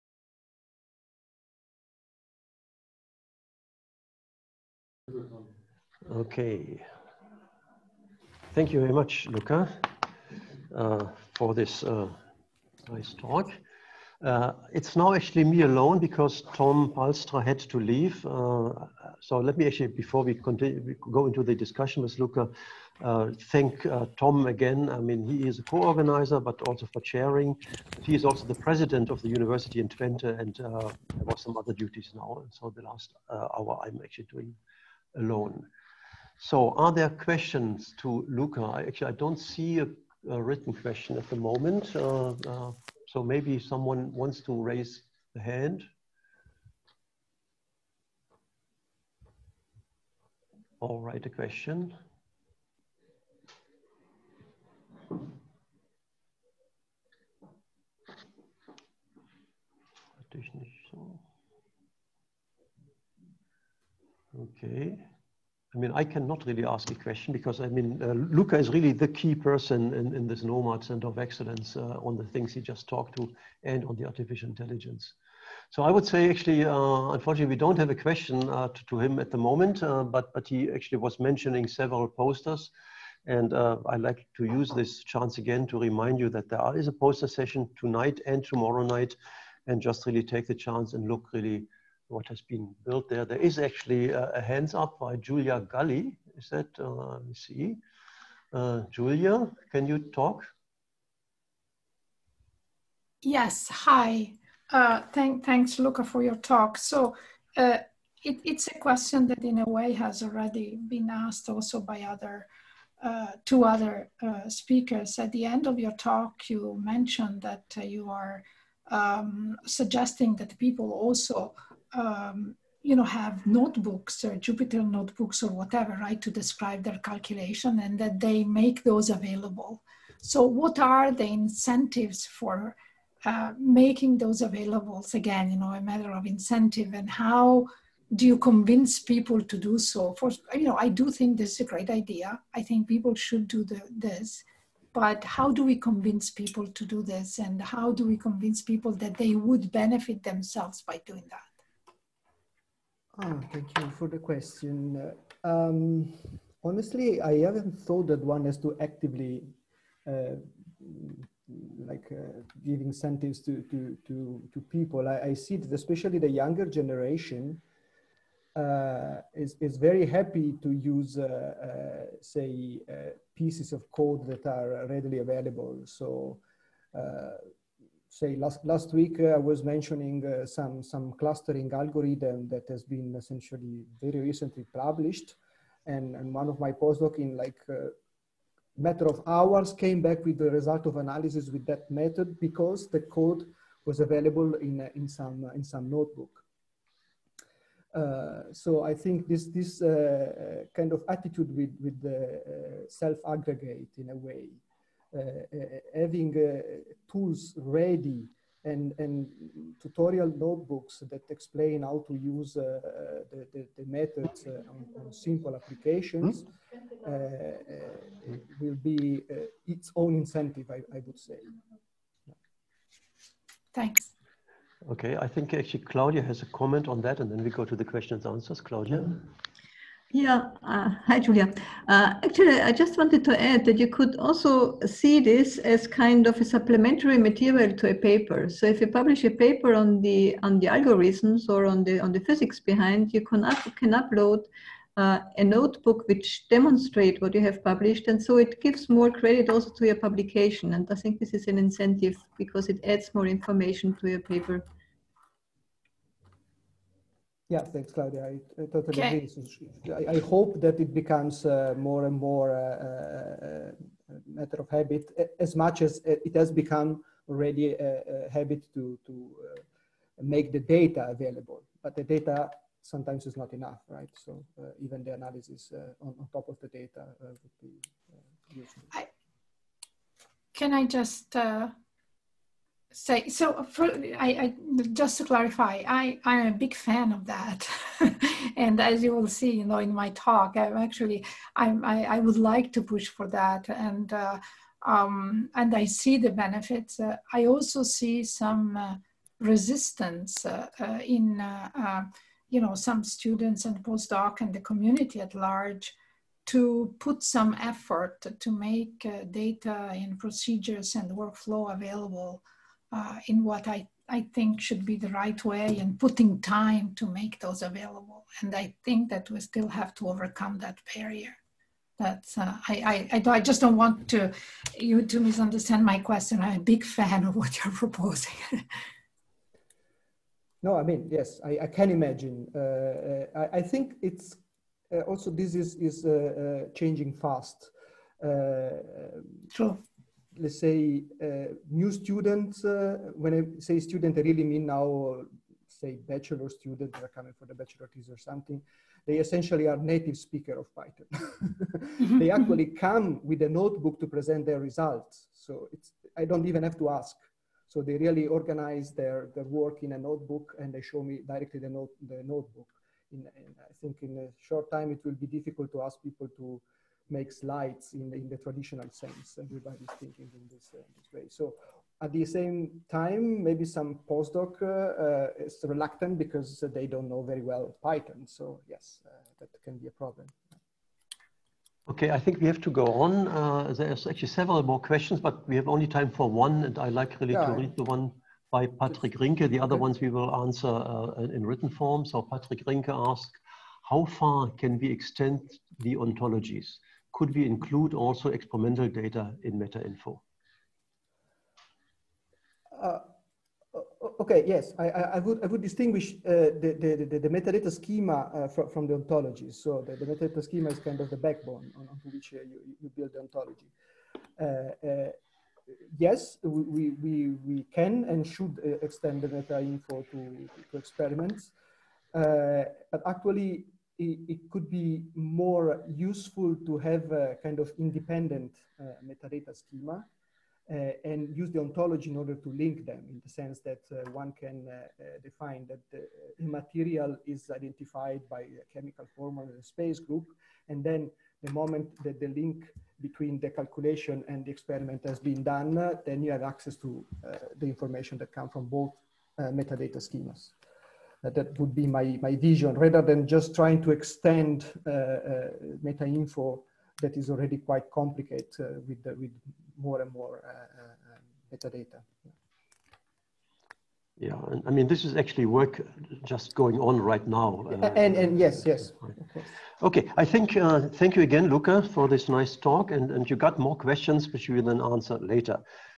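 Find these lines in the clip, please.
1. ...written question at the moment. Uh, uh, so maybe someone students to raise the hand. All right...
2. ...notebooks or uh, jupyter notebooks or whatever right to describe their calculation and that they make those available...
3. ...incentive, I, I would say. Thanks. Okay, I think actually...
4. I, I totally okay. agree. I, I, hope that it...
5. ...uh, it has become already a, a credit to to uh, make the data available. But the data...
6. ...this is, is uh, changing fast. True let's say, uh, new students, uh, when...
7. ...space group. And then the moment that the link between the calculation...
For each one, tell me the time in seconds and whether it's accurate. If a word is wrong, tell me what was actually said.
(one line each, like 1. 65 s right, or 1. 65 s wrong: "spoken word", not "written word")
1. 40 s wrong: "wants", not "students"
2. 123 s right
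3. 220 s right
4. 258 s right
5. 266 s wrong: "habit", not "credit"
6. 335 s right
7. 439 s right.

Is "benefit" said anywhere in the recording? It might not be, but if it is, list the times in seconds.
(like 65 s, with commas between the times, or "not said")
149 s, 296 s.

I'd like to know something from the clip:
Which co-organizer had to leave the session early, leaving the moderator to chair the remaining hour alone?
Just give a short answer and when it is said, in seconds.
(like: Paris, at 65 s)
Tom Palstra, at 16 s.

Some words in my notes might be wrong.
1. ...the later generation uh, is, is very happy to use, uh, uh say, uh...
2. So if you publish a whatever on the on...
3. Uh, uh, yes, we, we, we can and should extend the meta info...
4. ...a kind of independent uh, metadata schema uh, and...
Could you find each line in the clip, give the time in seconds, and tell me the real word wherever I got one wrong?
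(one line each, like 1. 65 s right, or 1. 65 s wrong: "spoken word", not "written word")
1. 166 s wrong: "younger", not "later"
2. 238 s wrong: "paper", not "whatever"
3. 414 s right
4. 427 s right.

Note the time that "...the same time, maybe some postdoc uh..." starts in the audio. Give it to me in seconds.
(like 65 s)
372 s.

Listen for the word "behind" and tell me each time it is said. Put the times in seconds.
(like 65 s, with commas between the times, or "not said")
242 s.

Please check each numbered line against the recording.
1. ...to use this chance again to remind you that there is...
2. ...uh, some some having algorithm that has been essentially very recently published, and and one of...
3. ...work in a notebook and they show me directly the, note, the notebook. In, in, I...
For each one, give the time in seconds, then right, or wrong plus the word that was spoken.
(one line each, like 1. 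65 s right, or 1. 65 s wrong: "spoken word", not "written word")
1. 84 s right
2. 180 s wrong: "clustering", not "having"
3. 359 s right.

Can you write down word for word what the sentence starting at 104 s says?
Uh, thank, thanks, Luca, for your talk.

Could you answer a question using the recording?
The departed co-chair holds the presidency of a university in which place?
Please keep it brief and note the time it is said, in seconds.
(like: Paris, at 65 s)
Twente, at 29 s.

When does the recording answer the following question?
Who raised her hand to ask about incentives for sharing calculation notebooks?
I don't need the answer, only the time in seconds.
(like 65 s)
95 s.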